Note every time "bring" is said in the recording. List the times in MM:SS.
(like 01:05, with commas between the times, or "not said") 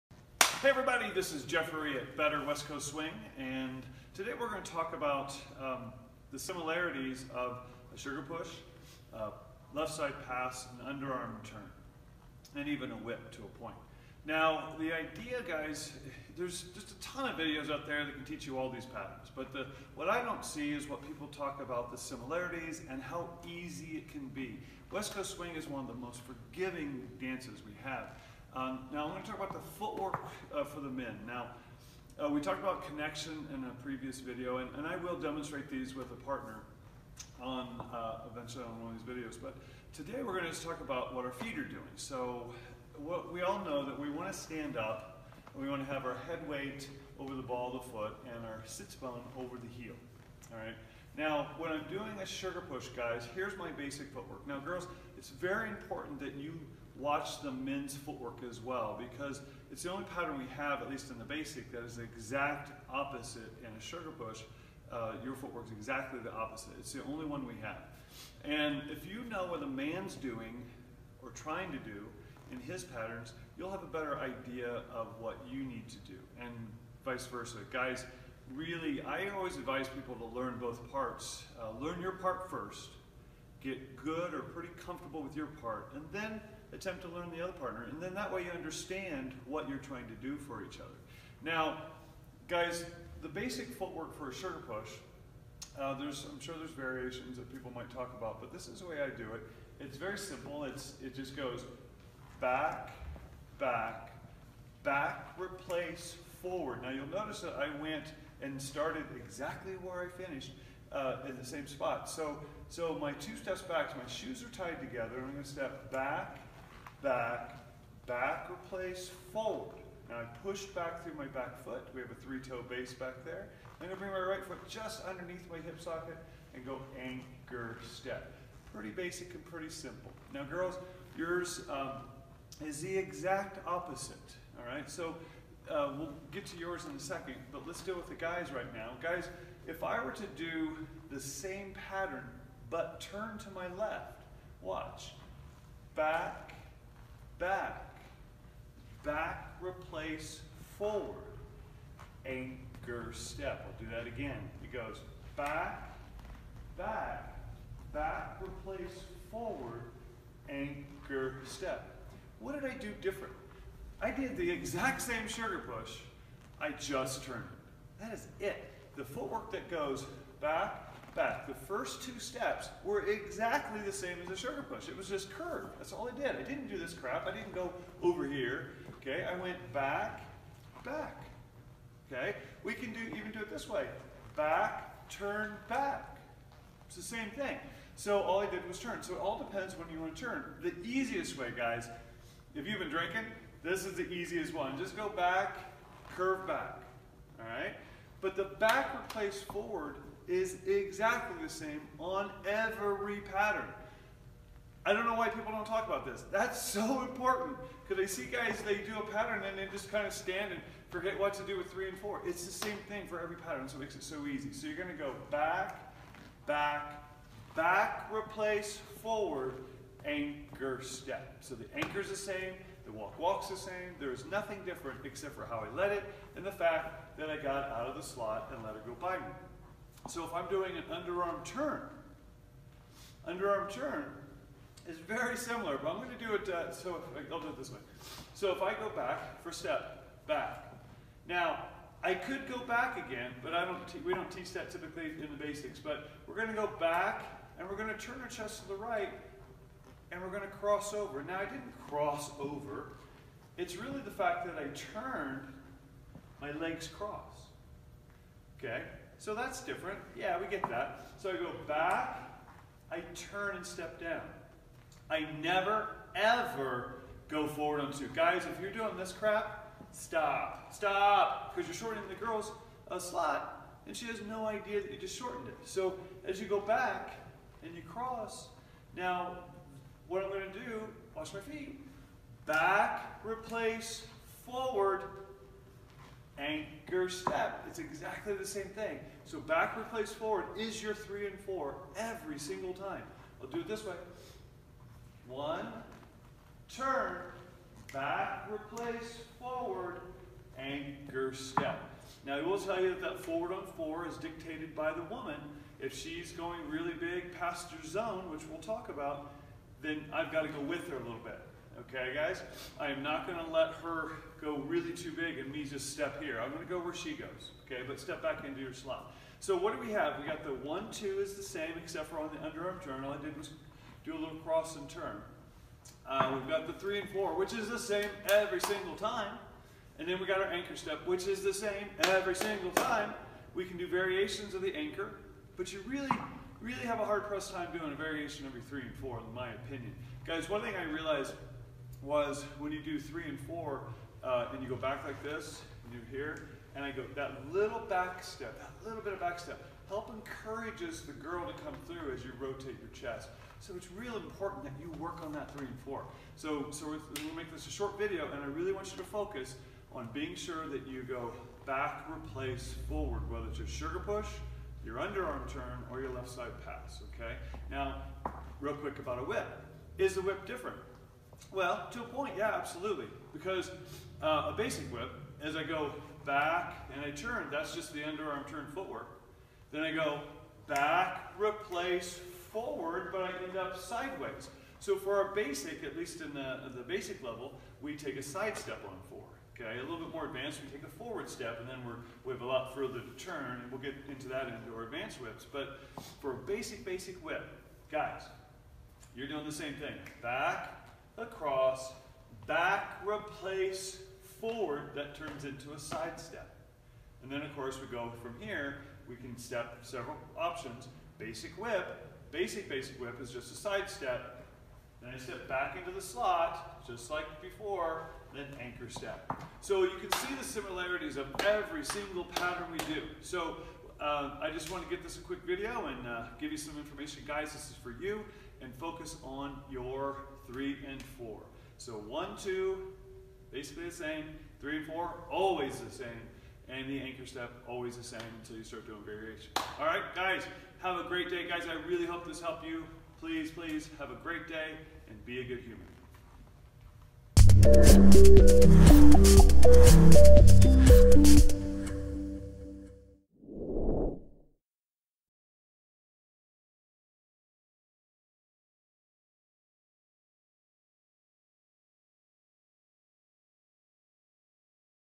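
02:03.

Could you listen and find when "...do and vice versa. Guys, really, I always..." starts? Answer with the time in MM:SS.
01:15.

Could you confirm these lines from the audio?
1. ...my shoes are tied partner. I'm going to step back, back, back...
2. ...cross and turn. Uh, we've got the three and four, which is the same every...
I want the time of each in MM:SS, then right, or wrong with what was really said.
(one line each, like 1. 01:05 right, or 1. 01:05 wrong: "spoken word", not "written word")
1. 01:53 wrong: "together", not "partner"
2. 05:24 right.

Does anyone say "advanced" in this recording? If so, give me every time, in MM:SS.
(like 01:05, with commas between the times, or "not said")
06:30, 06:34.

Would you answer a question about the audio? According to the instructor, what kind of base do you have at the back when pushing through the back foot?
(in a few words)
three-toe base.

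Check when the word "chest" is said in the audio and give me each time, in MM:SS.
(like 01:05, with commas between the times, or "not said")
04:08, 05:52.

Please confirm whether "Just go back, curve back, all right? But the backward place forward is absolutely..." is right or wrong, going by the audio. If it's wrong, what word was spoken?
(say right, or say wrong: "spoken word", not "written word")
wrong: "exactly", not "absolutely".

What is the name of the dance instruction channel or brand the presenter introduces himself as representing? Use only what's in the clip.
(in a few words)
Better West Coast Swing.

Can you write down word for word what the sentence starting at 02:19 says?
Guys, if I were to do the same pattern, but turn to my left, watch.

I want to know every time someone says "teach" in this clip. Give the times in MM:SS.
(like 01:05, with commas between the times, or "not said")
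00:18, 04:04.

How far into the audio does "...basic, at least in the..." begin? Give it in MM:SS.
06:25.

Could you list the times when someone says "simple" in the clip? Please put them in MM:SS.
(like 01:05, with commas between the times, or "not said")
01:40, 02:09.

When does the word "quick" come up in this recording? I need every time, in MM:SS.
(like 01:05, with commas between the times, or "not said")
06:08, 07:05.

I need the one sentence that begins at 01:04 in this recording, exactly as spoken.
Uh, your footwork is exactly the opposite.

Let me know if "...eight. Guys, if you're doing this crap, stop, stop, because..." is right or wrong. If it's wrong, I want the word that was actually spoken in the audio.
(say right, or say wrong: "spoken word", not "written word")
wrong: "two", not "eight".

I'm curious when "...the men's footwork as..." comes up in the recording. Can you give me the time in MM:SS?
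00:57.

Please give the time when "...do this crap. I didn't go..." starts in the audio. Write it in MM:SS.
02:56.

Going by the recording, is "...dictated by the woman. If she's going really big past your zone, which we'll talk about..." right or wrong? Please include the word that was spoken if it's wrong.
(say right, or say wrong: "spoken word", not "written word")
right.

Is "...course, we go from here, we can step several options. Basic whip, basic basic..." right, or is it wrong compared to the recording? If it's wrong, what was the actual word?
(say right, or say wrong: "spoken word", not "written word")
right.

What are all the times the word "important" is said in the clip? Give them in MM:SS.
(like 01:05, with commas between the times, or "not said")
00:55, 03:27, 05:54.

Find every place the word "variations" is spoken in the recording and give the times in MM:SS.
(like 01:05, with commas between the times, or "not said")
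01:36, 05:33, 05:37, 07:19.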